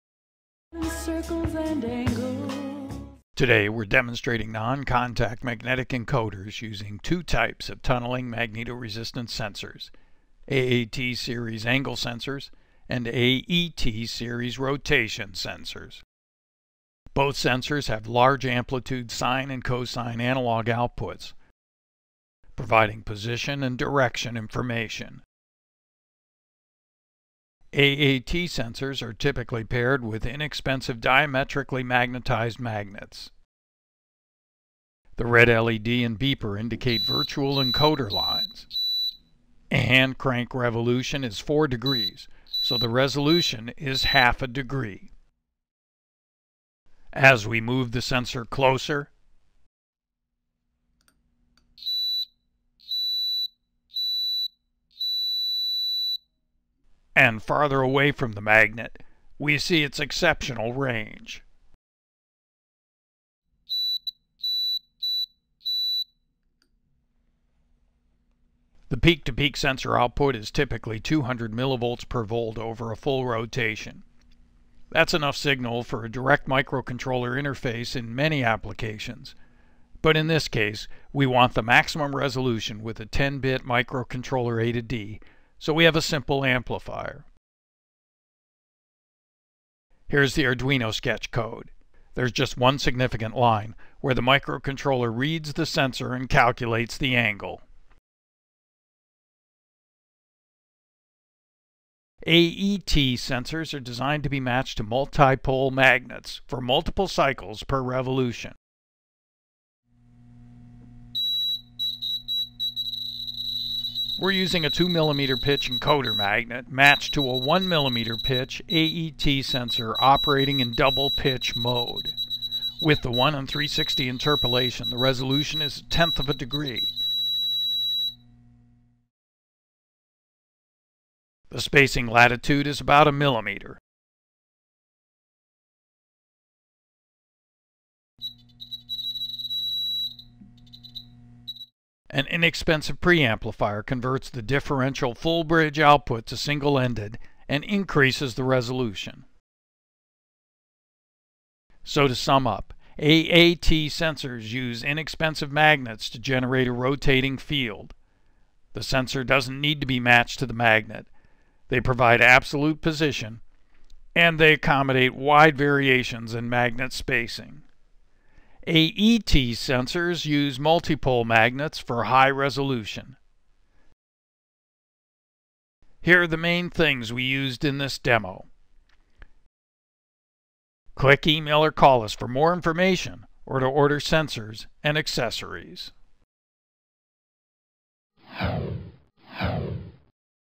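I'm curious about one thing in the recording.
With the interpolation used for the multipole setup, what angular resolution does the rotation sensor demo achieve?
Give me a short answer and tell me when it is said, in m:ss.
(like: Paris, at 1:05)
a tenth of a degree, at 2:05.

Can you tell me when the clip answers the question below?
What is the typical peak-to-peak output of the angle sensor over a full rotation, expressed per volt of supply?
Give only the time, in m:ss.
1:10.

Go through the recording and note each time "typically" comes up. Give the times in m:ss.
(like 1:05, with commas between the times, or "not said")
0:29, 1:10.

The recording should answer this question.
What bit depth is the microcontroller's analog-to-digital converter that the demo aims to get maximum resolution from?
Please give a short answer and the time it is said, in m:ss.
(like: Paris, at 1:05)
10-bit, at 1:23.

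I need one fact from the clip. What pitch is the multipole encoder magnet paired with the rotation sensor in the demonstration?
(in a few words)
2 millimeter.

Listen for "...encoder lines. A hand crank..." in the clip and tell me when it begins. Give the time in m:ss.
0:37.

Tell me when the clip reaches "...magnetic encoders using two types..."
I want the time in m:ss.
0:05.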